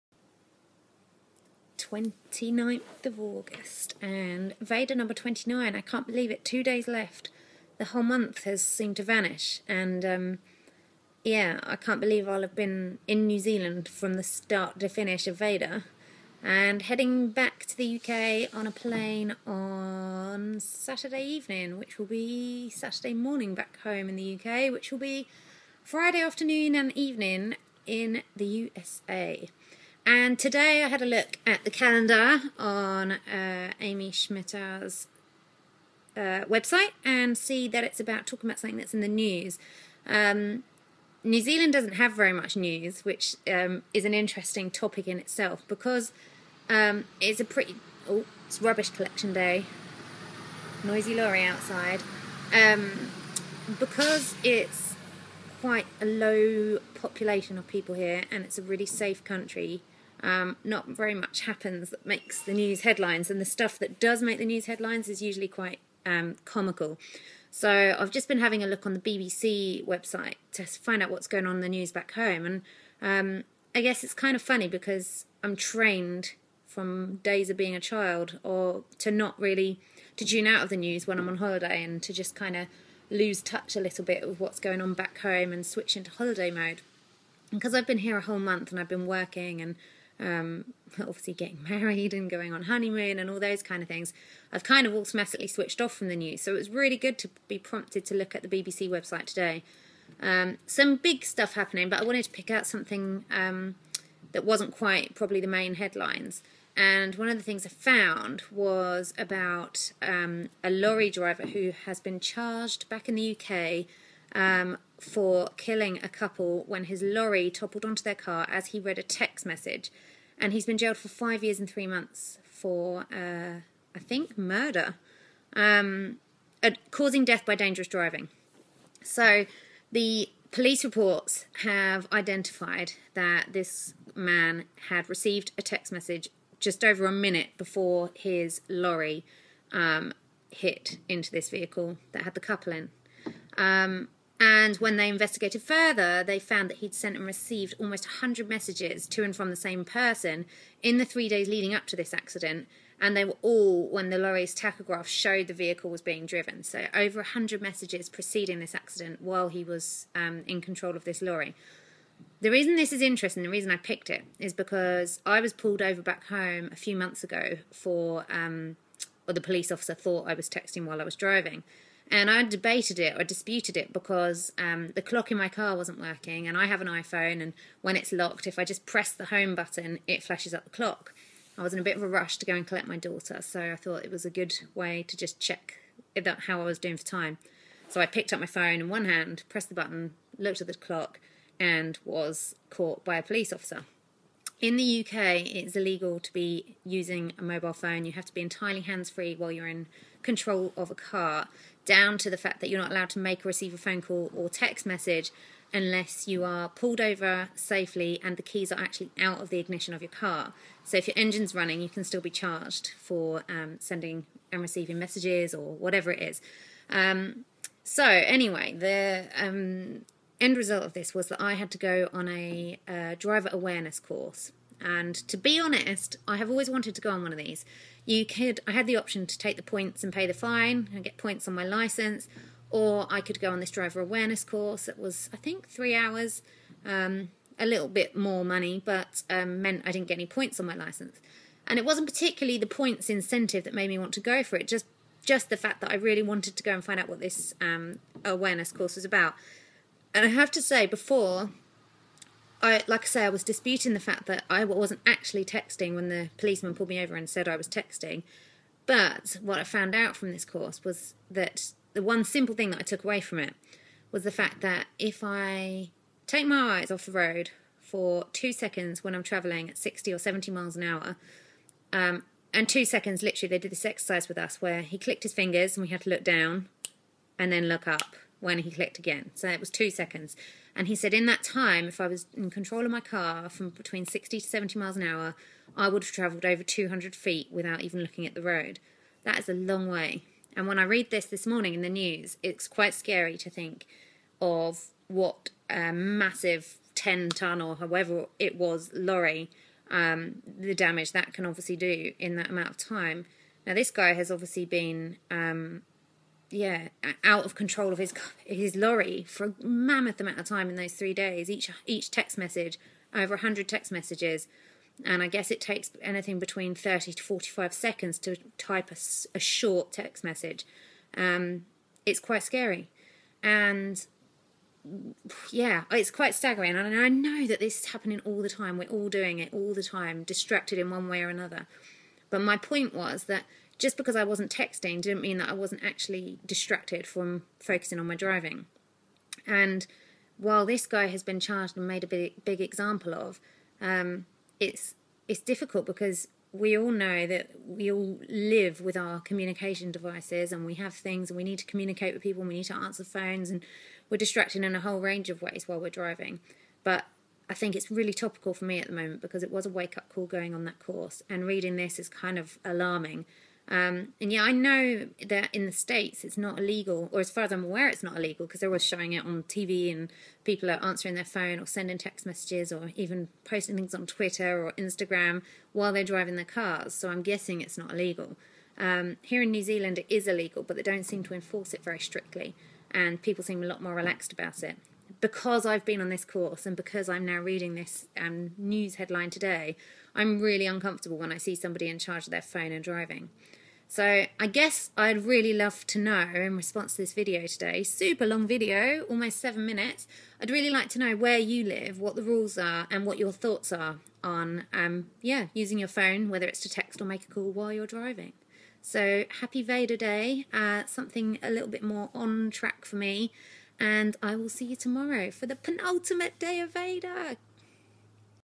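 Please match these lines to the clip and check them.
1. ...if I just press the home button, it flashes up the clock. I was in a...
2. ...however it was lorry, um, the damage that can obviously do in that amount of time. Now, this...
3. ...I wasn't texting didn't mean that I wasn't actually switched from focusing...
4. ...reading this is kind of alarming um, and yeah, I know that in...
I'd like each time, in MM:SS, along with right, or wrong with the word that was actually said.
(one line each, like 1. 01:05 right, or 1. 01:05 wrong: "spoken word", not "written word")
1. 02:58 right
2. 04:57 right
3. 05:34 wrong: "distracted", not "switched"
4. 06:01 right.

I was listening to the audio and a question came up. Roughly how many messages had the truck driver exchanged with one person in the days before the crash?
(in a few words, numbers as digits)
100.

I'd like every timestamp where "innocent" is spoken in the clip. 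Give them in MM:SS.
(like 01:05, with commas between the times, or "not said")
not said.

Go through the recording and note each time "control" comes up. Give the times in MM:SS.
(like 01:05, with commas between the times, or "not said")
02:40, 03:20, 04:42, 05:07.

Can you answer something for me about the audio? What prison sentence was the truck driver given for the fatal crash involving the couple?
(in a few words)
5 years and 3 months.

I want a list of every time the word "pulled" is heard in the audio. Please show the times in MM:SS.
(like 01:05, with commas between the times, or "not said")
02:45, 03:26, 04:16.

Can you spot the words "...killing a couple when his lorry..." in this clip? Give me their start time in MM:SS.
01:55.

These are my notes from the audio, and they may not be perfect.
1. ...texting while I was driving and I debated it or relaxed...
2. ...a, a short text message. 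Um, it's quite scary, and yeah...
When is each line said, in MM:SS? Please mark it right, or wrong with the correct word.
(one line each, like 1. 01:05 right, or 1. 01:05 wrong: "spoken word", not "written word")
1. 02:50 wrong: "disputed", not "relaxed"
2. 05:18 right.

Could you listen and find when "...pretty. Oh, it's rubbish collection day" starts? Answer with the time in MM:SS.
00:47.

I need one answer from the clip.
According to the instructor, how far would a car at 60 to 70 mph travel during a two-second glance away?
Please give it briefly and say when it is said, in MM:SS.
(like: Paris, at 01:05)
over 200 feet, at 04:46.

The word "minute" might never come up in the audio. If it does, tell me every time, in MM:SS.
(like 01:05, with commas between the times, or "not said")
02:17, 06:39.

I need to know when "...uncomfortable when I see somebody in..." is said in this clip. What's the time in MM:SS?
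06:30.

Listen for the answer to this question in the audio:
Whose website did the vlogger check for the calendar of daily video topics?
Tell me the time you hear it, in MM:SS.
00:33.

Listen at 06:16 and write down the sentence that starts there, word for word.
So I'm guessing it's not illegal.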